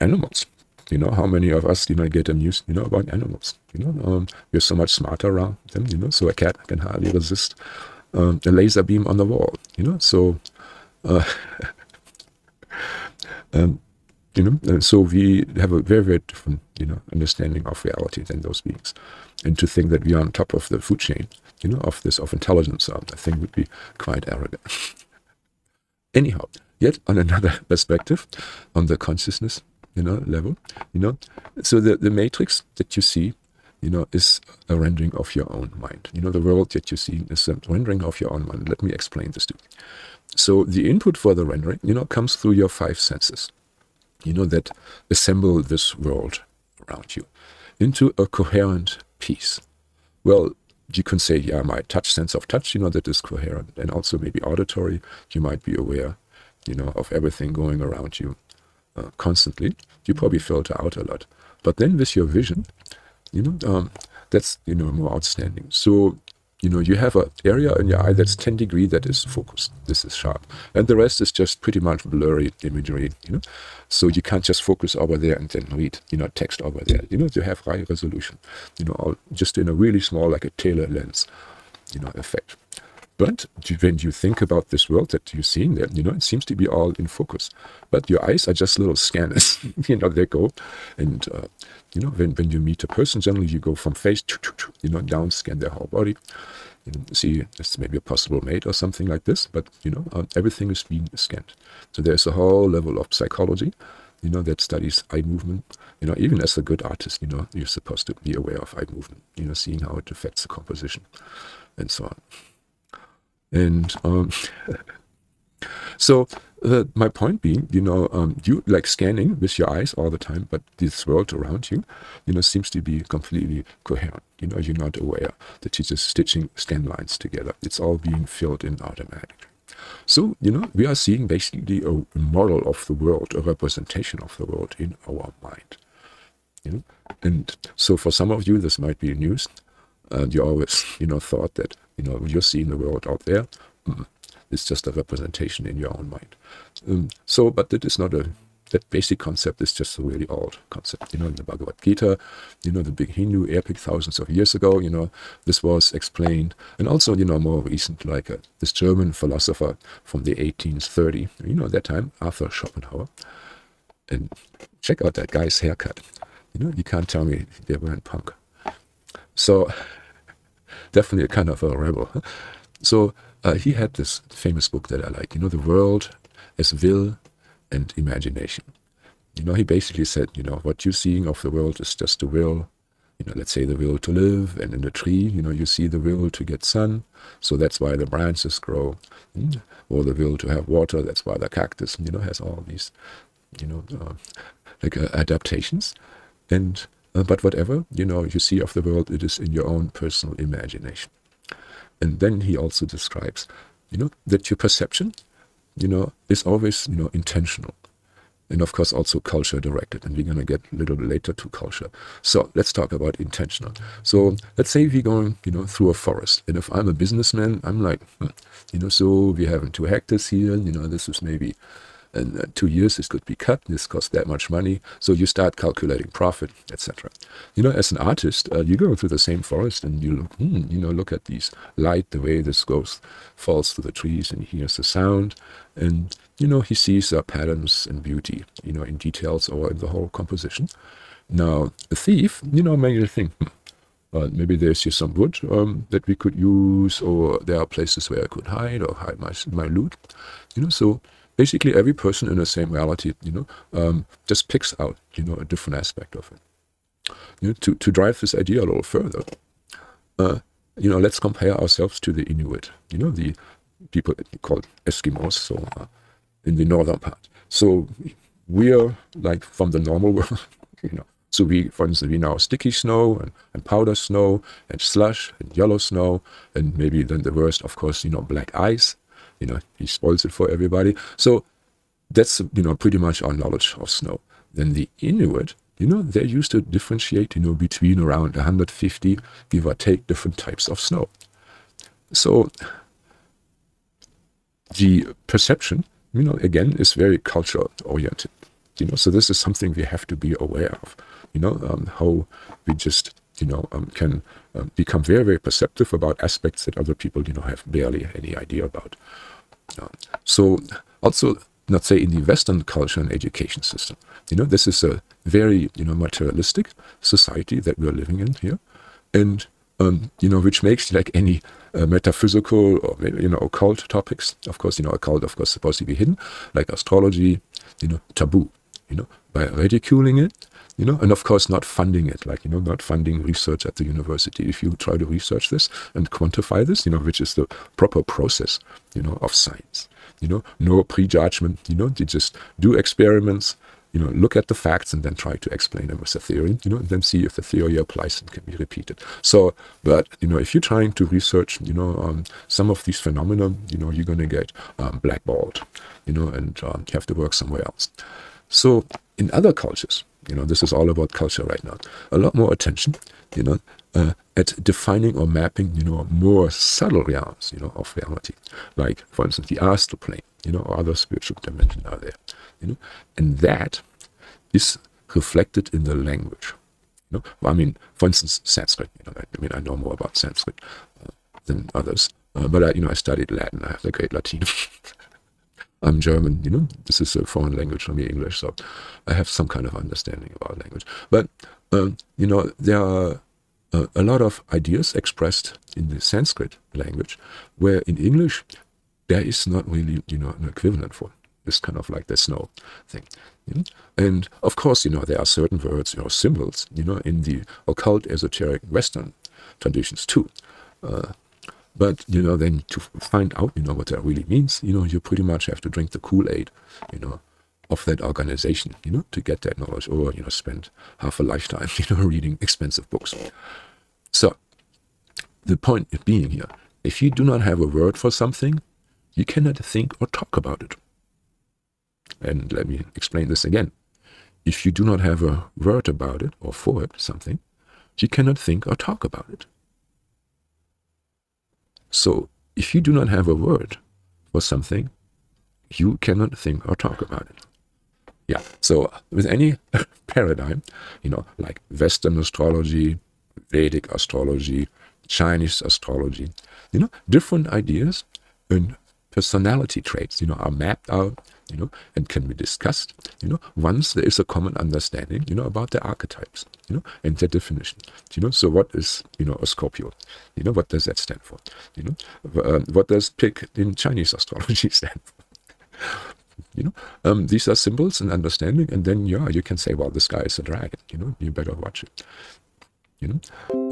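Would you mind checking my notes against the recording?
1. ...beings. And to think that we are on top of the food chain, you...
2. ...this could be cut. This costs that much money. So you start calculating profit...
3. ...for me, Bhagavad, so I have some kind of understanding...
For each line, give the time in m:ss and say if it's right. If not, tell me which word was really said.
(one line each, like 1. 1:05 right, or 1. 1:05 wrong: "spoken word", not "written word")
1. 0:18 right
2. 3:42 right
3. 6:27 wrong: "English", not "Bhagavad".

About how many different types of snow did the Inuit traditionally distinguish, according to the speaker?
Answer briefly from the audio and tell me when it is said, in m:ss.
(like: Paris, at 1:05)
150, at 4:48.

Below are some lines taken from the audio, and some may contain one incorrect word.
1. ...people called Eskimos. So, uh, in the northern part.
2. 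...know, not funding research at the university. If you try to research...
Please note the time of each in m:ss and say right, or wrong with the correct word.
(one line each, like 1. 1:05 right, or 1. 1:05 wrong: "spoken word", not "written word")
1. 4:23 right
2. 5:32 right.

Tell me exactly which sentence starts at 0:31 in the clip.
So the, the matrix that you see, you know, is a rendering of your own mind.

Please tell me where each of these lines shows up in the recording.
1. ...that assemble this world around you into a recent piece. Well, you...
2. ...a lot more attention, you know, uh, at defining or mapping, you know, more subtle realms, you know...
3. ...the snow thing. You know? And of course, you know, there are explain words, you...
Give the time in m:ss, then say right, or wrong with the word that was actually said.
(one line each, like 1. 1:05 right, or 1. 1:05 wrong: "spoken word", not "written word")
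1. 0:44 wrong: "coherent", not "recent"
2. 6:02 right
3. 6:42 wrong: "certain", not "explain".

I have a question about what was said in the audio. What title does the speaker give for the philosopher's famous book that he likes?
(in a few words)
The World as Will and Imagination.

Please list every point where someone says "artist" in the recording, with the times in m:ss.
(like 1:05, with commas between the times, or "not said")
1:46, 3:47.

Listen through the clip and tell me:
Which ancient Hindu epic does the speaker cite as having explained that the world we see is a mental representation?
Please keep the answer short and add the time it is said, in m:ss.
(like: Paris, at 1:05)
Bhagavad Gita, at 2:31.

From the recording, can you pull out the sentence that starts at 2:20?
And you always, you know, thought that, you know, you're seeing the world out there.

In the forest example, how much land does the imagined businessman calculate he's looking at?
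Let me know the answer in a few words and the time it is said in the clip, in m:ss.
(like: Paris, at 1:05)
2 hectares, at 3:39.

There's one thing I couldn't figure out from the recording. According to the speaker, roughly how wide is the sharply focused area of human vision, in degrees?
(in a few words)
10 degrees.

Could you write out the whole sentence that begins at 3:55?
And, you know, he sees uh, patterns and beauty, you know, in details or in the whole composition.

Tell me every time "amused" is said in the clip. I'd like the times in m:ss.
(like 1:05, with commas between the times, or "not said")
0:02.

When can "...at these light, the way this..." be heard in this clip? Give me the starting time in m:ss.
3:51.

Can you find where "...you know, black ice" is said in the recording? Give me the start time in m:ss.
4:38.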